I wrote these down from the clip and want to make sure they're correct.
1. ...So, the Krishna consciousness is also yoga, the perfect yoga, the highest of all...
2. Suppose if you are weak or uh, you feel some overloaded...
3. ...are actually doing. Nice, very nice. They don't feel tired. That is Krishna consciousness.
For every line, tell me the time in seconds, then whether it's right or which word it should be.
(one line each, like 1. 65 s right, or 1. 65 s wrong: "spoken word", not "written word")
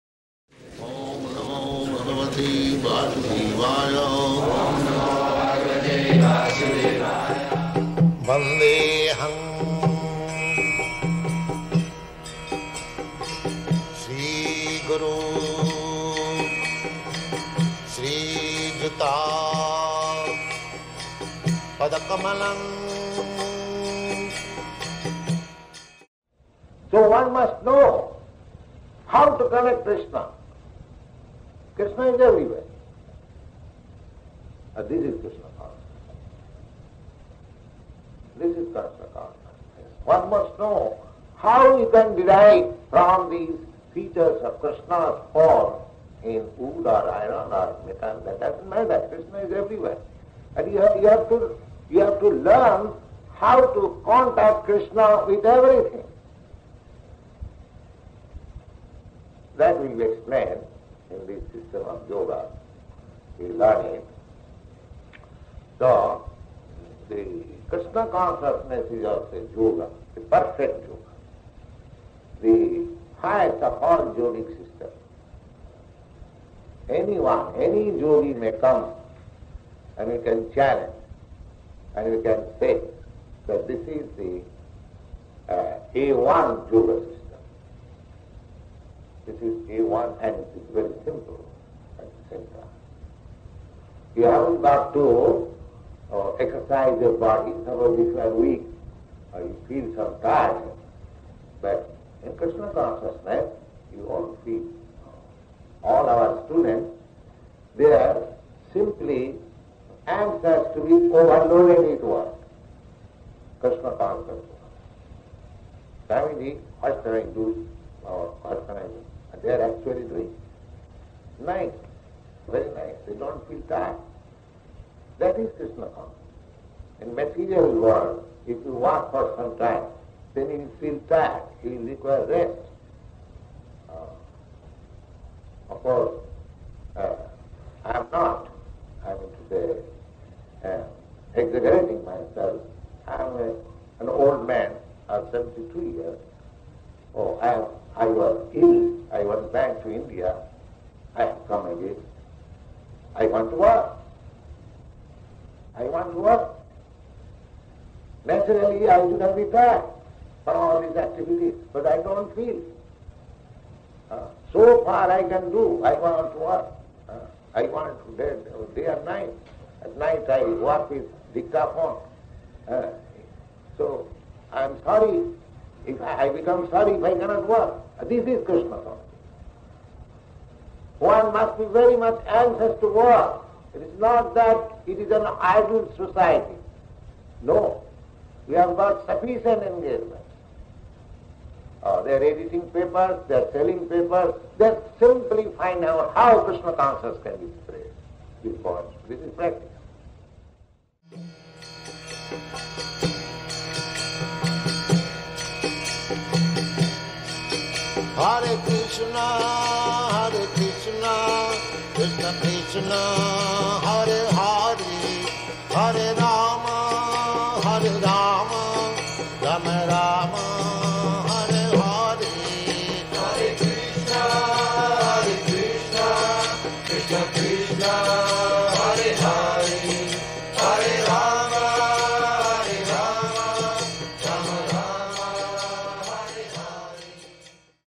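1. 65 s right
2. 97 s wrong: "tired", not "overloaded"
3. 119 s right.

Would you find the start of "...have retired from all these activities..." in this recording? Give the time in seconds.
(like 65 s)
159 s.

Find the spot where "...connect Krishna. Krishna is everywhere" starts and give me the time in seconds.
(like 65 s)
29 s.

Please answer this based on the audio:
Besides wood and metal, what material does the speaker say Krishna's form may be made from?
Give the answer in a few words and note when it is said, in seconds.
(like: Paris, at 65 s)
Iron, at 47 s.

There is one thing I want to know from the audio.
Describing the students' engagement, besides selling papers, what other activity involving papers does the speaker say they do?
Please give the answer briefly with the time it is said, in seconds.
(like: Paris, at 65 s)
Editing, at 192 s.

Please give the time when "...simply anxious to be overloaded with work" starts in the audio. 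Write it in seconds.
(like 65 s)
108 s.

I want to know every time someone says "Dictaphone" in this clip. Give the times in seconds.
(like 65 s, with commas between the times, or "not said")
171 s.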